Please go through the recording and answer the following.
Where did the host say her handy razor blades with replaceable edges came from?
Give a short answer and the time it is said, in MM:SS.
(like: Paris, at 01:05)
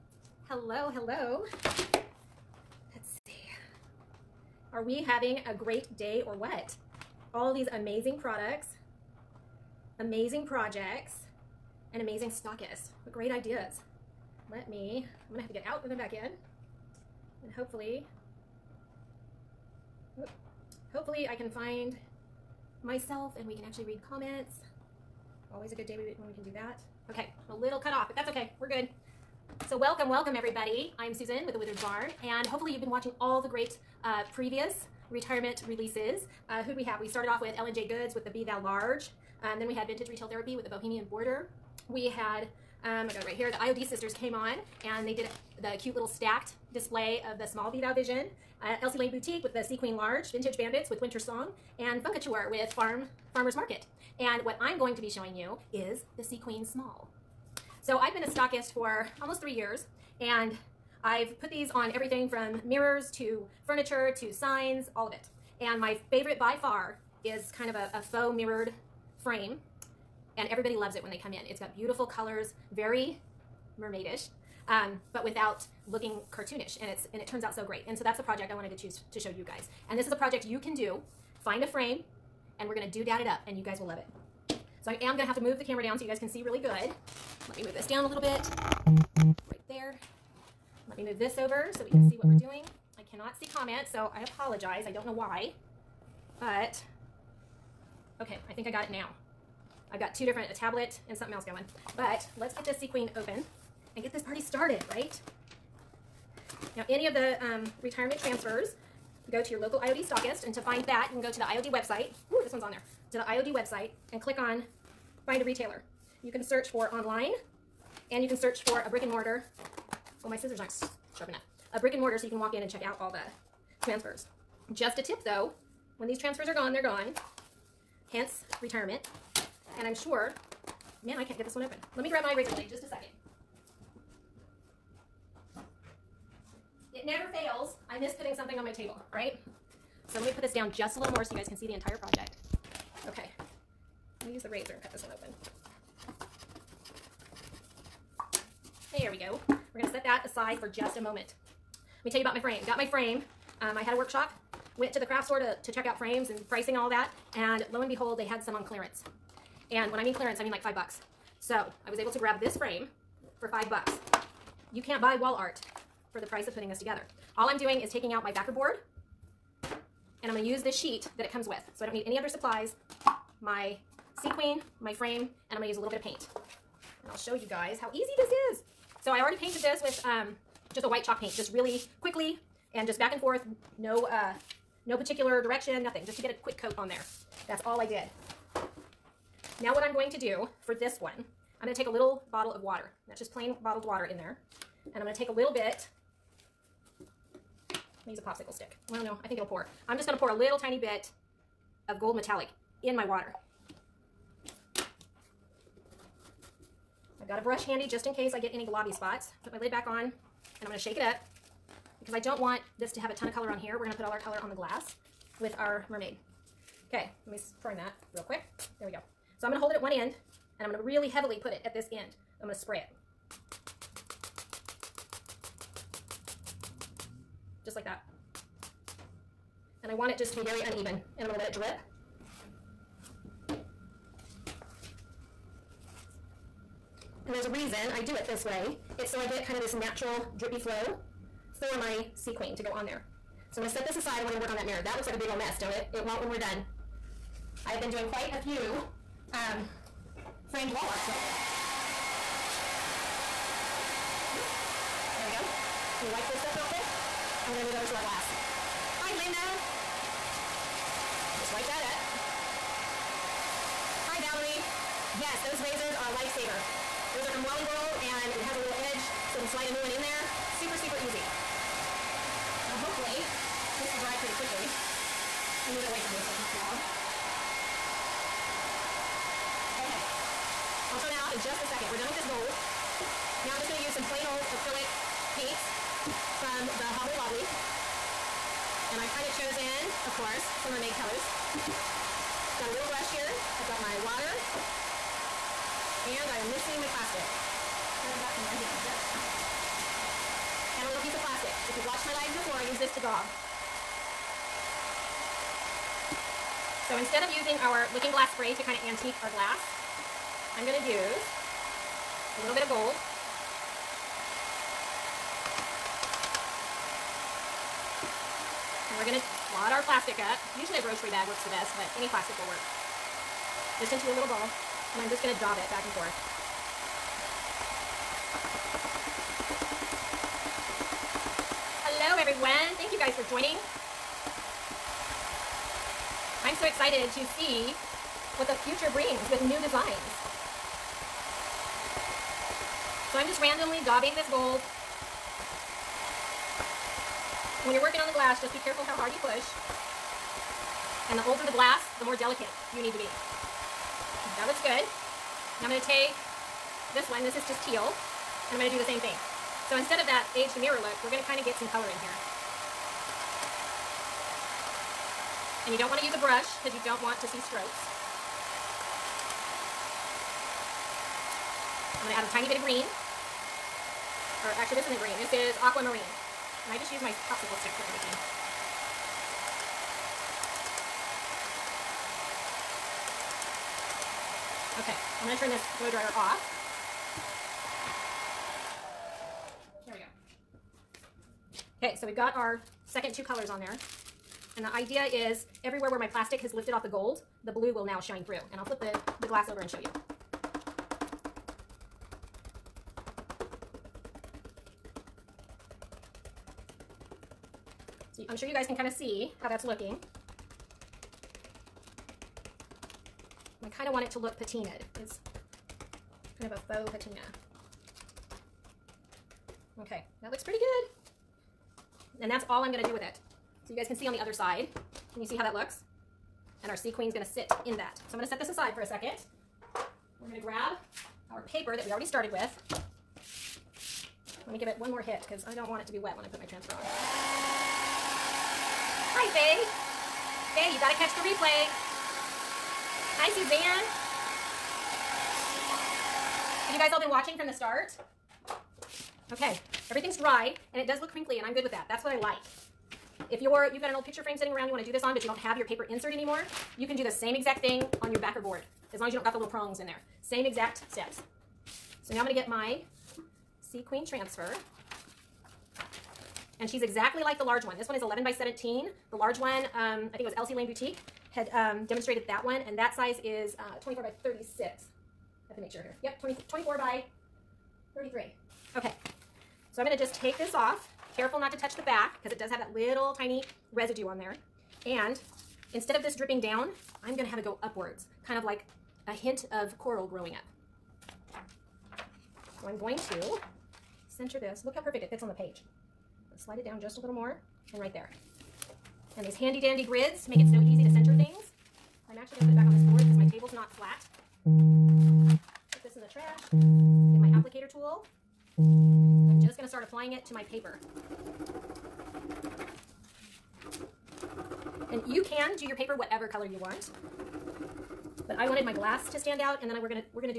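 Wally World, at 04:27.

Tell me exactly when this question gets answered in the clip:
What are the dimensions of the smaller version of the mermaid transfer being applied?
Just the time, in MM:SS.
07:48.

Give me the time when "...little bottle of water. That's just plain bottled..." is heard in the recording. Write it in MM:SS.
03:11.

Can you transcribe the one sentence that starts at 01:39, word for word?
I've got two different, a tablet and something else going.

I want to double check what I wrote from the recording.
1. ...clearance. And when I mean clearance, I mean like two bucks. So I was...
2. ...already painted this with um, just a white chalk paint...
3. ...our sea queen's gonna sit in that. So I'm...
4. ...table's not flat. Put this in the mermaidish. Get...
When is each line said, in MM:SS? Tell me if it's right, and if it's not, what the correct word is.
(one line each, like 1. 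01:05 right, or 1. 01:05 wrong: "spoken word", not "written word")
1. 02:38 wrong: "five", not "two"
2. 02:59 right
3. 07:06 right
4. 08:23 wrong: "trash", not "mermaidish".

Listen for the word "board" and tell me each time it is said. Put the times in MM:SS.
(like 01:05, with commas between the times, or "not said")
02:48, 07:38, 08:22.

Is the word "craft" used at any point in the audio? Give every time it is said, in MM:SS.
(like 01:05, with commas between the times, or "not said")
02:35.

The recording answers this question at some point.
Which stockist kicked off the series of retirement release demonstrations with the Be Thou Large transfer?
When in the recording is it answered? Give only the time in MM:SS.
00:37.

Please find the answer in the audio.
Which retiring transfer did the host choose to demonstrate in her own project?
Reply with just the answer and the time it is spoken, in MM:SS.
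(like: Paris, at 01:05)
Sea Queen Small, at 00:56.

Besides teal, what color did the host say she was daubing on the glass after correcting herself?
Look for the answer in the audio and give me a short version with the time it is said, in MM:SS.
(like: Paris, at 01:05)
aquamarine, at 06:15.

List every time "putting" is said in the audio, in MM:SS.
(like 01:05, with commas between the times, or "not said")
02:18, 02:46.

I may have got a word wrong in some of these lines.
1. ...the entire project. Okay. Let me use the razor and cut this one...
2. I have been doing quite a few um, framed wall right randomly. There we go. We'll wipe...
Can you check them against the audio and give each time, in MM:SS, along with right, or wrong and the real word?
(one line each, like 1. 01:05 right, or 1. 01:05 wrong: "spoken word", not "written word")
1. 02:21 right
2. 04:07 wrong: "lately", not "randomly".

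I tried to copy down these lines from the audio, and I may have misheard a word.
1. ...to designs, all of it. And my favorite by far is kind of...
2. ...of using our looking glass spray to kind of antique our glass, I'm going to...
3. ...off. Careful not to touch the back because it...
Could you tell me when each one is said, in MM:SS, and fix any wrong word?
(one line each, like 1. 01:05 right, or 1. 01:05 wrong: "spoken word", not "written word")
1. 01:04 wrong: "signs", not "designs"
2. 05:07 right
3. 08:00 right.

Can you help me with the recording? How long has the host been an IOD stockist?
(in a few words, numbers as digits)
almost three years.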